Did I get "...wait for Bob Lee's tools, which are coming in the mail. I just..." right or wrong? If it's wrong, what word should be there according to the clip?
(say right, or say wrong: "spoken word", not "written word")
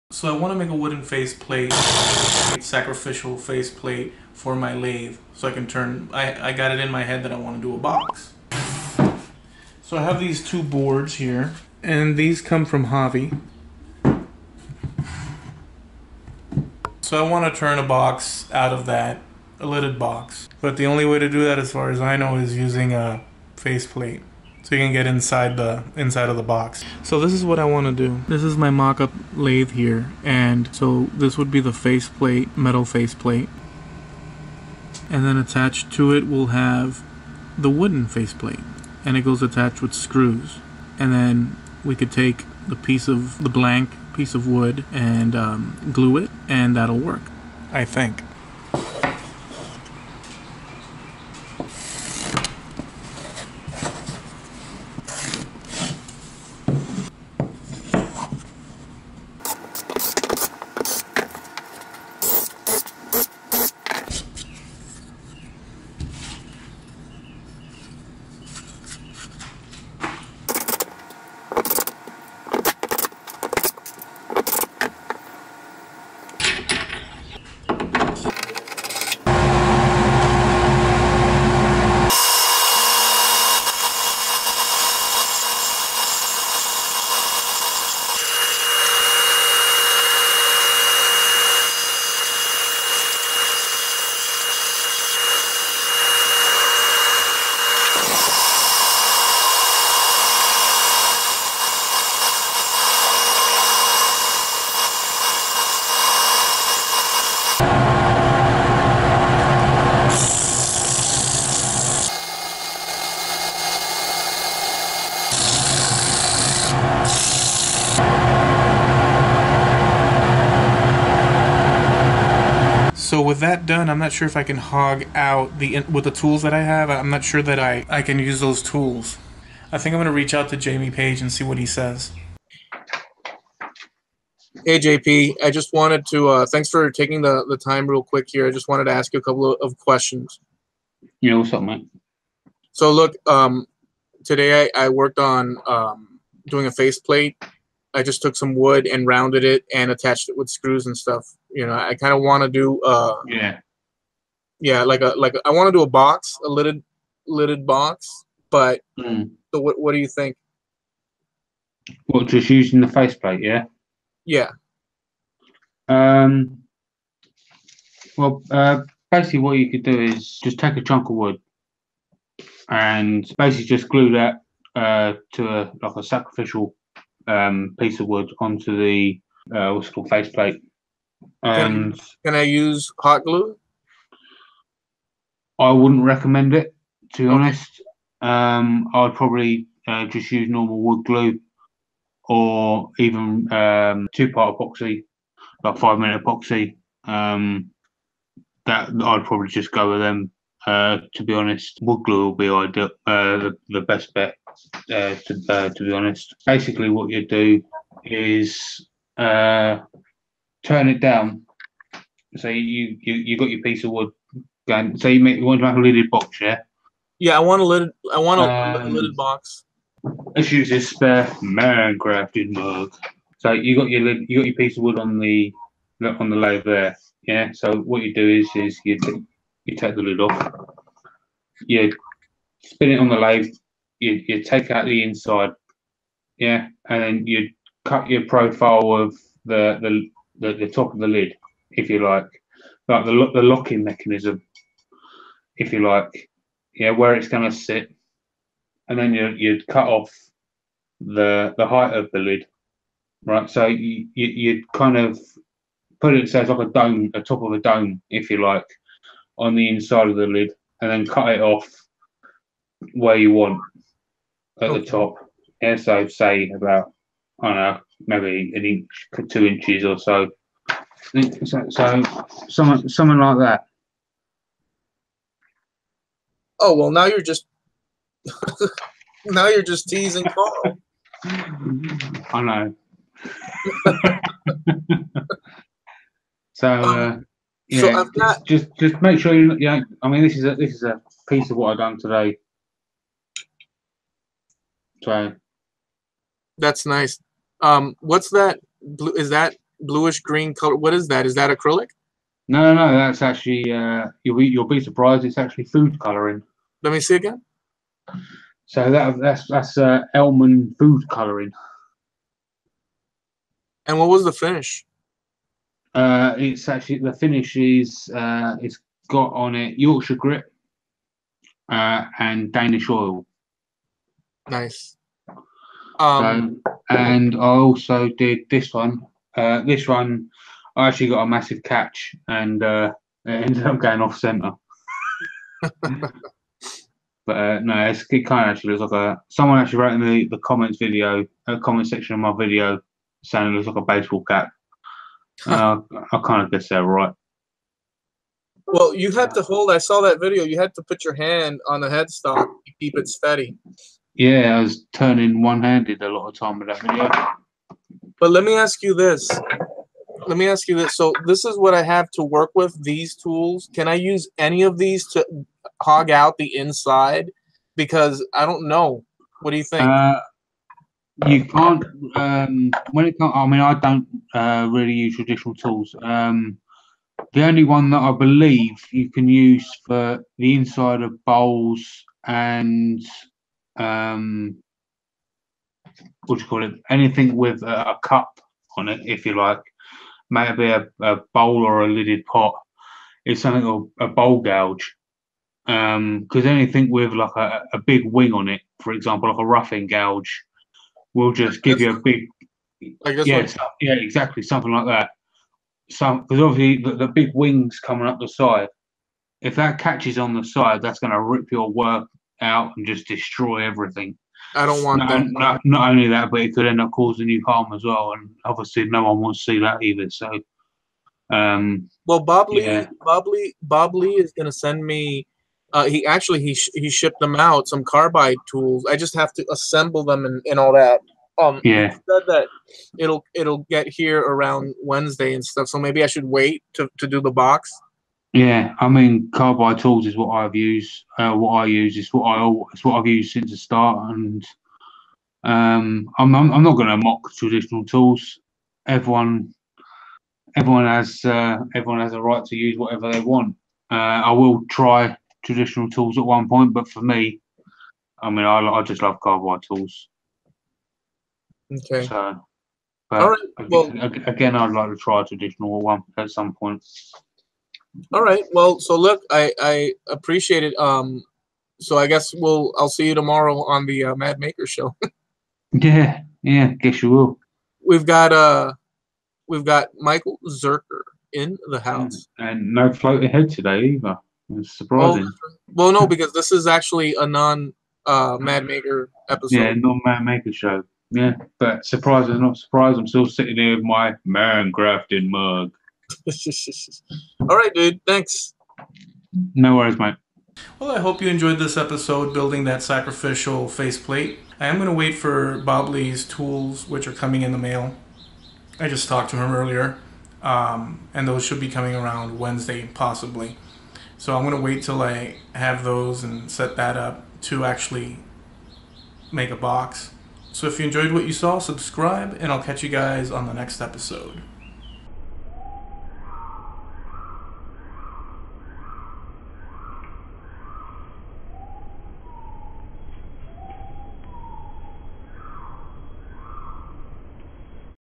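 right.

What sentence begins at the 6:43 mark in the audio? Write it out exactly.
Like yeah, so, yeah, exactly, something like that.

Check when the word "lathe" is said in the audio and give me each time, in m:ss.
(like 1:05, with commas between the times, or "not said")
0:04, 0:29, 3:53.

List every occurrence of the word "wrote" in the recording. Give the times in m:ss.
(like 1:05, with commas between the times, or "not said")
5:39.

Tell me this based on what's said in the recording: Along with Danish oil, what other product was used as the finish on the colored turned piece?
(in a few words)
Yorkshire grit.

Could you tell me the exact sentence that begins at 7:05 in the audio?
Uh, he actually he sh he shipped them out some carbide tools.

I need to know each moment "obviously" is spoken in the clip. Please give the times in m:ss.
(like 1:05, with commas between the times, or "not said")
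6:46, 6:58.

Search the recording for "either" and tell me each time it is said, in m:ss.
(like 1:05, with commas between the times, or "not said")
6:59, 8:03.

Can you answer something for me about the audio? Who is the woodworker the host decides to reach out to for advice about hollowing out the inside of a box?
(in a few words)
Jamie Page.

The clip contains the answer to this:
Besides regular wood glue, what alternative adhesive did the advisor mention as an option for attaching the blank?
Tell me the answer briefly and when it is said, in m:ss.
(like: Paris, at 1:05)
five minute epoxy, at 3:15.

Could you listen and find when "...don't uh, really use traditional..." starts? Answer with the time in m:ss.
6:13.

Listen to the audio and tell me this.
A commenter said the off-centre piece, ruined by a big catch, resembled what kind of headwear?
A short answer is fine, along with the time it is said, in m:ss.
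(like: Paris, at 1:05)
baseball cap, at 5:43.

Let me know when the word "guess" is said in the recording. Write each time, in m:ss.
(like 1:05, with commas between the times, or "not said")
5:46, 7:52, 7:56.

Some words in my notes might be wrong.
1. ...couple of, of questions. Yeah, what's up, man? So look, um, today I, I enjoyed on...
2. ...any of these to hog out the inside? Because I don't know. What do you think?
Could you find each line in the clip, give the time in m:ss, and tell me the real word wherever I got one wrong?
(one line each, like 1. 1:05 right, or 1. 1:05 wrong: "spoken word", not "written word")
1. 2:19 wrong: "worked", not "enjoyed"
2. 6:04 right.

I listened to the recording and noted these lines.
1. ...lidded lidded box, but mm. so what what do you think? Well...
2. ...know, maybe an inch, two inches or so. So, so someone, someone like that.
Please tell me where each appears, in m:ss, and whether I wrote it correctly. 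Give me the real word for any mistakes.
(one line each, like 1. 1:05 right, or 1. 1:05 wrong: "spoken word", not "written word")
1. 2:36 right
2. 4:27 right.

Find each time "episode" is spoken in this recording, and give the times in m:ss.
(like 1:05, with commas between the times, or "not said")
8:09, 8:21, 8:43.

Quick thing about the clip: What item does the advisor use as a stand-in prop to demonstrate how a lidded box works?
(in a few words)
Minecrafting mug.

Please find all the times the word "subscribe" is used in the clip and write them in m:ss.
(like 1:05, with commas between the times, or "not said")
8:41.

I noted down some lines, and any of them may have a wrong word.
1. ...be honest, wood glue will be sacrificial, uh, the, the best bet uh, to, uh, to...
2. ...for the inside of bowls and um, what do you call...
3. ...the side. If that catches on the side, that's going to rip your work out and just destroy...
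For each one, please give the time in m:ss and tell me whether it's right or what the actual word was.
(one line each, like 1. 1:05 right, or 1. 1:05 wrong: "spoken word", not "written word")
1. 3:21 wrong: "ideal", not "sacrificial"
2. 6:19 right
3. 6:48 right.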